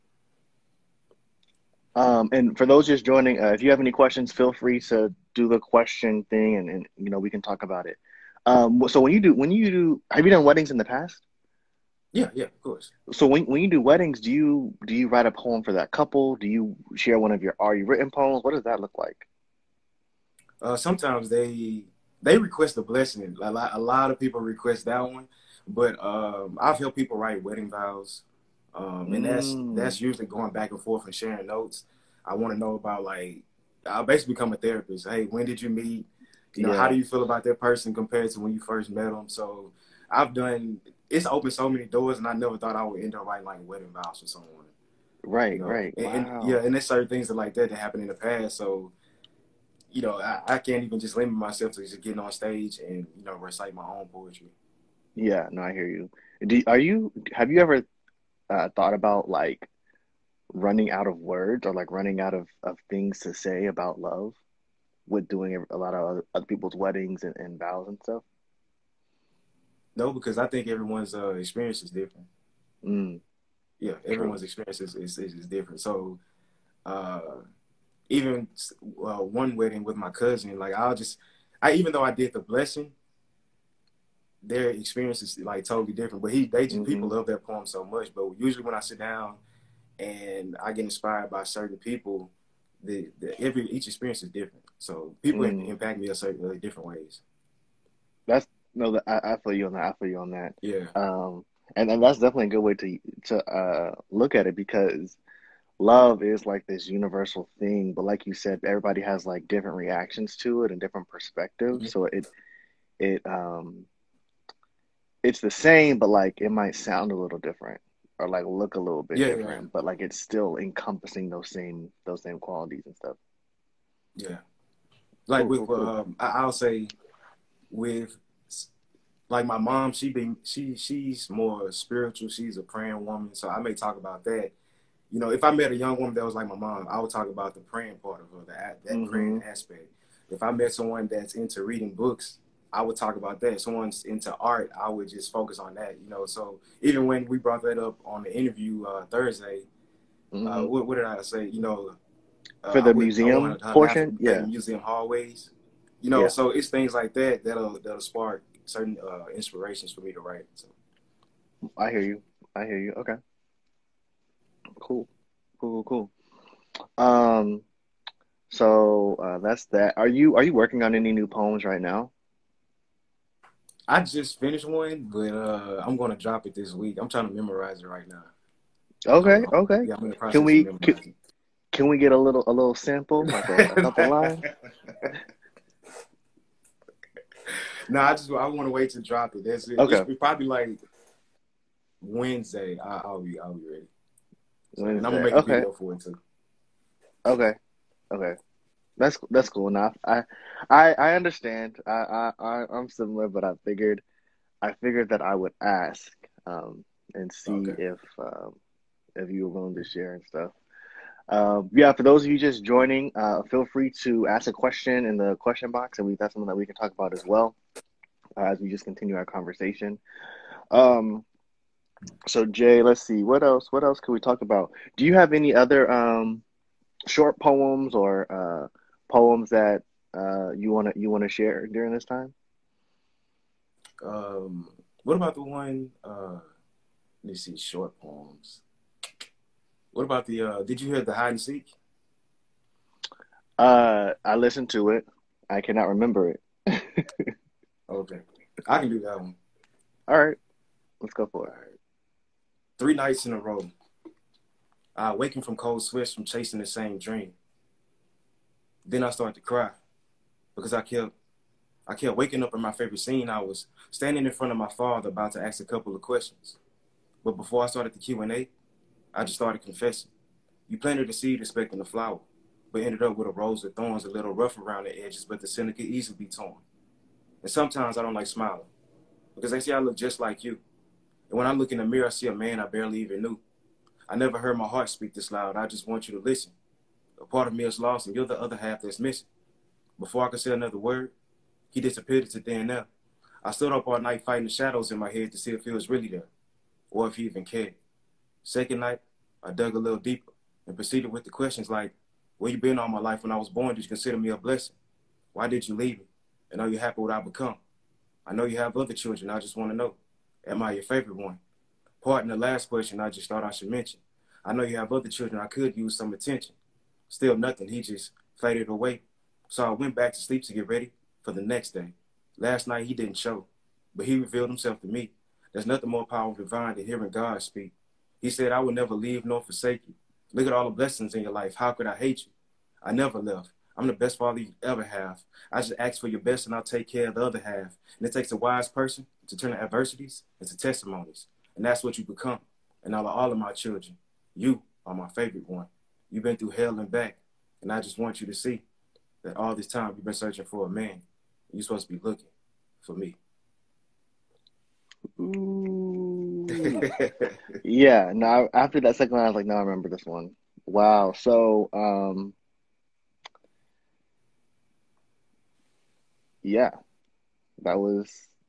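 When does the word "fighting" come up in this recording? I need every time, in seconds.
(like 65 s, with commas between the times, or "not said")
294 s.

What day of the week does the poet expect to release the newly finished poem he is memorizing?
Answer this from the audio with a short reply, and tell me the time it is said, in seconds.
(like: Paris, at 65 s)
Wednesday, at 192 s.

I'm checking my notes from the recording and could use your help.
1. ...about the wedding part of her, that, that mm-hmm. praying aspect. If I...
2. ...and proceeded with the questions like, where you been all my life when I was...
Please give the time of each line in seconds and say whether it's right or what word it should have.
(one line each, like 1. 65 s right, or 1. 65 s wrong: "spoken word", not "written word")
1. 137 s wrong: "praying", not "wedding"
2. 300 s right.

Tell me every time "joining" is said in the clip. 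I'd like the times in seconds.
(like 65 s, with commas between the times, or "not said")
3 s, 212 s.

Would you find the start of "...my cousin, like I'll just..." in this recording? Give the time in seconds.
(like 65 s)
79 s.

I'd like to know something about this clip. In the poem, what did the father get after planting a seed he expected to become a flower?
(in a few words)
A rose.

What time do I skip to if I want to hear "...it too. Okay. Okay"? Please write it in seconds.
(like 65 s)
195 s.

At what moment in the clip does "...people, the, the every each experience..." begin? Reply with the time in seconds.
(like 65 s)
91 s.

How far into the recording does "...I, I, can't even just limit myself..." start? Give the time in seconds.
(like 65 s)
50 s.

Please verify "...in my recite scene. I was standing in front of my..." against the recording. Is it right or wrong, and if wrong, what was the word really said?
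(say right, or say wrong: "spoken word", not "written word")
wrong: "favorite", not "recite".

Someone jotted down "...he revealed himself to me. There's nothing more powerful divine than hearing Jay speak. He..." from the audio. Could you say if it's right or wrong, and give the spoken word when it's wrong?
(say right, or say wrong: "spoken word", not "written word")
wrong: "God", not "Jay".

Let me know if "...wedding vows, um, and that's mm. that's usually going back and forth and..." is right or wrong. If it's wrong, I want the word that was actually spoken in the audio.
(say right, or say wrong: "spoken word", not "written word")
right.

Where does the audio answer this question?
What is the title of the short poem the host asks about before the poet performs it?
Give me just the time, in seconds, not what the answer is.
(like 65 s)
241 s.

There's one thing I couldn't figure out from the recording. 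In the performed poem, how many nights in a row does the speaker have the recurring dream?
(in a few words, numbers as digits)
3.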